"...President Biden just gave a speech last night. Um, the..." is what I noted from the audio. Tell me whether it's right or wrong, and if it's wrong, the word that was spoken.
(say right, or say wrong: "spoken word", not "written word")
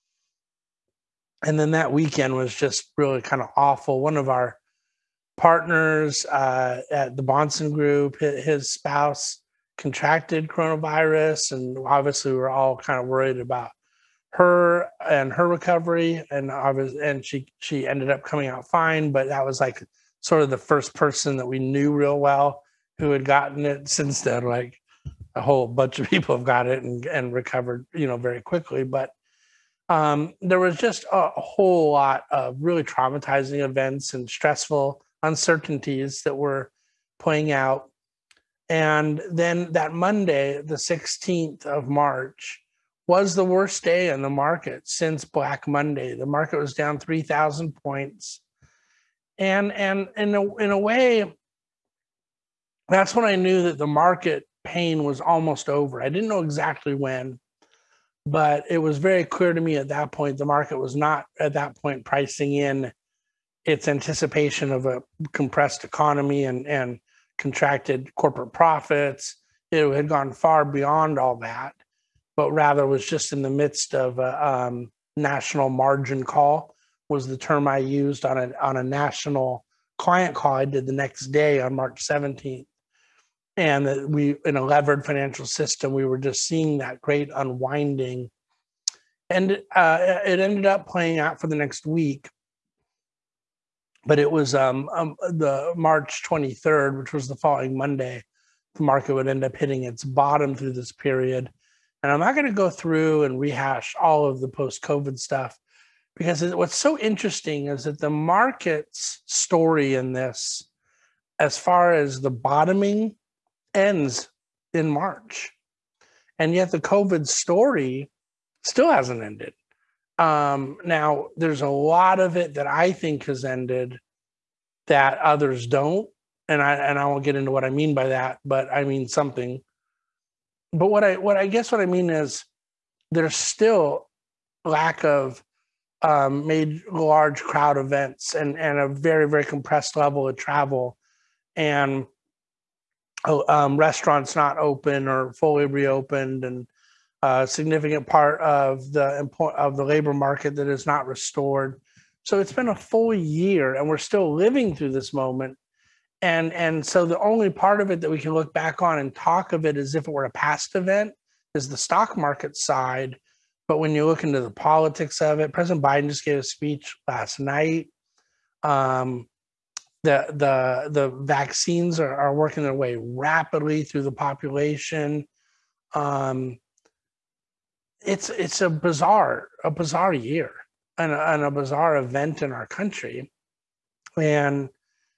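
right.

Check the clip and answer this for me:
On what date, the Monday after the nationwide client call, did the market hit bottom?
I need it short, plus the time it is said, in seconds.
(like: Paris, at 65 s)
March 23rd, at 95 s.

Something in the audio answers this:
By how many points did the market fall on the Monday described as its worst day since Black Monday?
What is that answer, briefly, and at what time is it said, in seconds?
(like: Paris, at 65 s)
3,000, at 46 s.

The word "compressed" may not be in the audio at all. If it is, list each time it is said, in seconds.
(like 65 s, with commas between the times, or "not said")
65 s, 139 s.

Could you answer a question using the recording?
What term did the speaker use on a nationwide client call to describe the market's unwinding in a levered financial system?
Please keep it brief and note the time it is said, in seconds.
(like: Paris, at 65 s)
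national margin call, at 75 s.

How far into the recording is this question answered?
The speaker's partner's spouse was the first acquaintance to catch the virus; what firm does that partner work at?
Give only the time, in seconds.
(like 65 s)
7 s.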